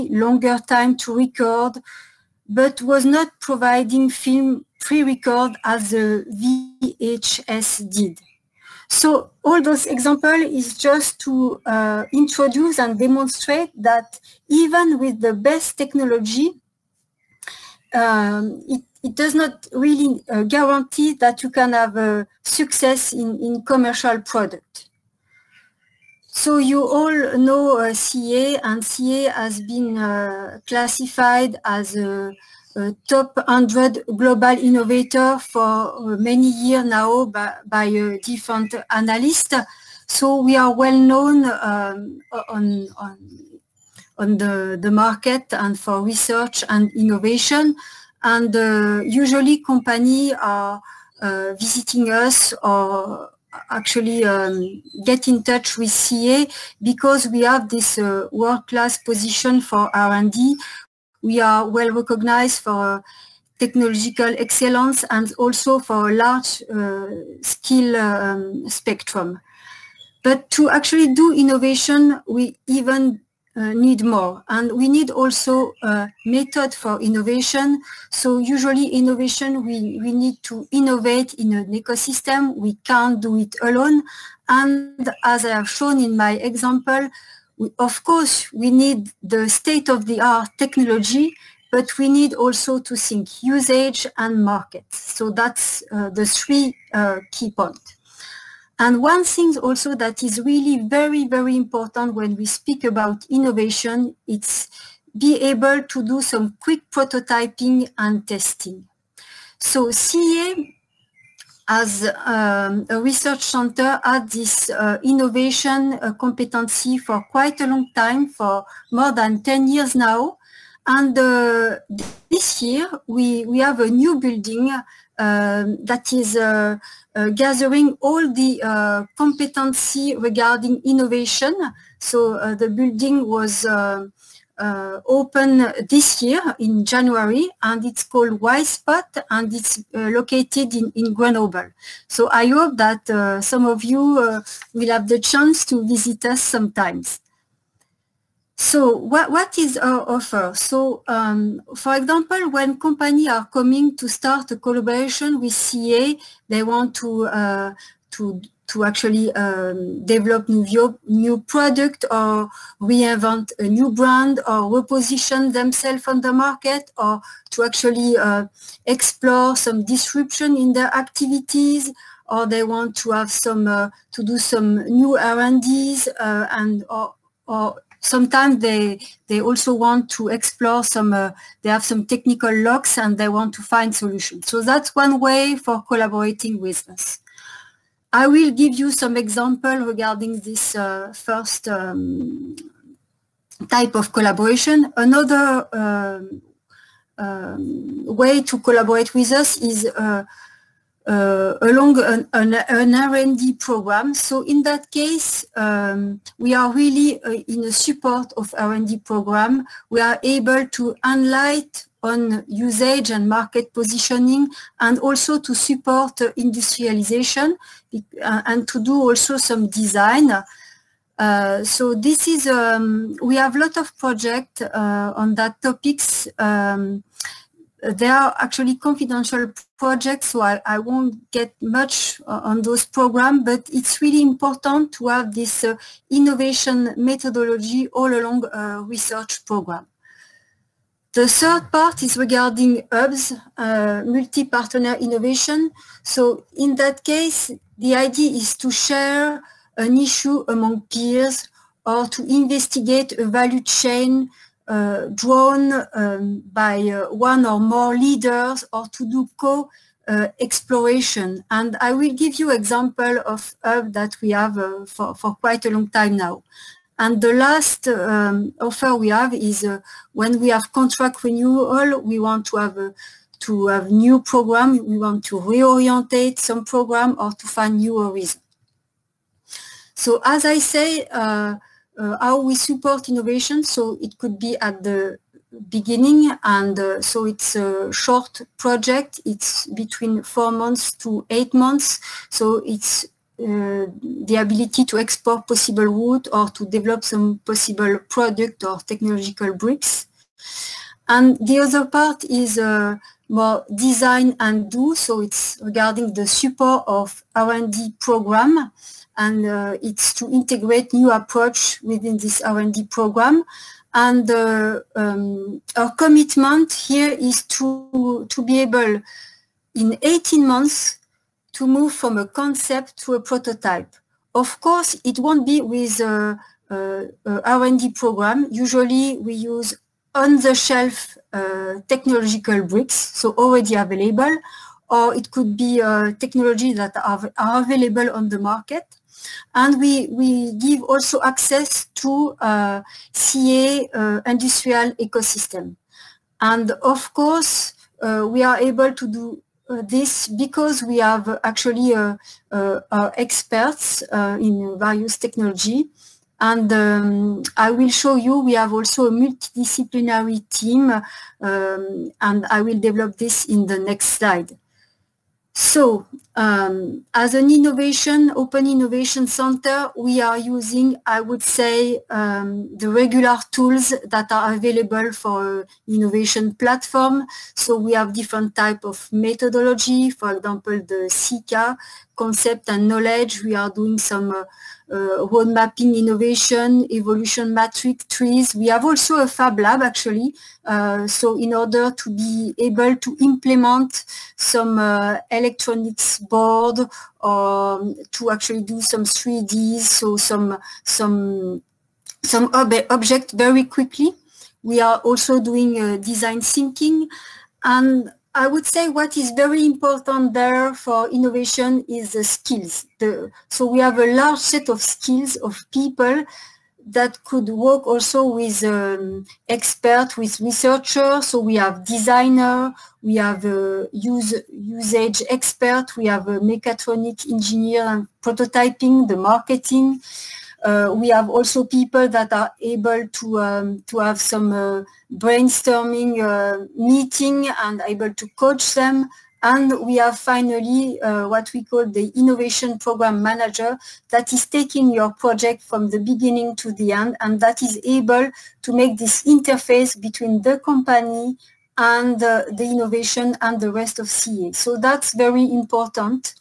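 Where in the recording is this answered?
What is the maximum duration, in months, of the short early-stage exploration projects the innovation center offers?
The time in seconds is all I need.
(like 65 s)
291 s.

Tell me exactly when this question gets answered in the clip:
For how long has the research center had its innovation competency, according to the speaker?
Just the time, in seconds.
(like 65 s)
118 s.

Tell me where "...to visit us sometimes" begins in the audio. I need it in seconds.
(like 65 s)
145 s.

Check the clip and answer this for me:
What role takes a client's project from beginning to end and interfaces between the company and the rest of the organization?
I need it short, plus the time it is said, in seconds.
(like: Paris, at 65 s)
innovation program manager, at 442 s.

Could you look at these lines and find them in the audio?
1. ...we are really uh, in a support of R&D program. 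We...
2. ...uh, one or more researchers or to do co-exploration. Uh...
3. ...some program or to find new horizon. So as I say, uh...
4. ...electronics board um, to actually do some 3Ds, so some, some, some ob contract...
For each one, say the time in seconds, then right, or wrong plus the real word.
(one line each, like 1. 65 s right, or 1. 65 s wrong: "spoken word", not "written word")
1. 206 s right
2. 256 s wrong: "leaders", not "researchers"
3. 276 s right
4. 395 s wrong: "object", not "contract".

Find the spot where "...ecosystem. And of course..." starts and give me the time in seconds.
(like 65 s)
344 s.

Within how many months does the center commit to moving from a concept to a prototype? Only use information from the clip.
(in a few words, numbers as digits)
18 months.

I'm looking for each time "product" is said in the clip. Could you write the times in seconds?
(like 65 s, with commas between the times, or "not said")
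24 s, 161 s, 298 s.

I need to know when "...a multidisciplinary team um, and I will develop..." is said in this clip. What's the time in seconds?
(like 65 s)
359 s.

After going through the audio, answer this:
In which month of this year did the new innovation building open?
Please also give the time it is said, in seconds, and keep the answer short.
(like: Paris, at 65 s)
January, at 136 s.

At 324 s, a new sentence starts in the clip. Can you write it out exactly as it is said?
Of course, it won't be with uh, uh, a, a, a R&D program.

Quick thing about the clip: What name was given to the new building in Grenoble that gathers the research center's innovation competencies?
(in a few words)
Y-Spot.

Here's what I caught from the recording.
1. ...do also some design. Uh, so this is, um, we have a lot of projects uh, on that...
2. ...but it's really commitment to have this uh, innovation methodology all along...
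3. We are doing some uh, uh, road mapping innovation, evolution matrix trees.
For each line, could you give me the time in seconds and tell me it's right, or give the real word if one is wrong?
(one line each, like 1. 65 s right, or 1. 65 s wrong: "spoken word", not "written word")
1. 218 s right
2. 233 s wrong: "important", not "commitment"
3. 383 s right.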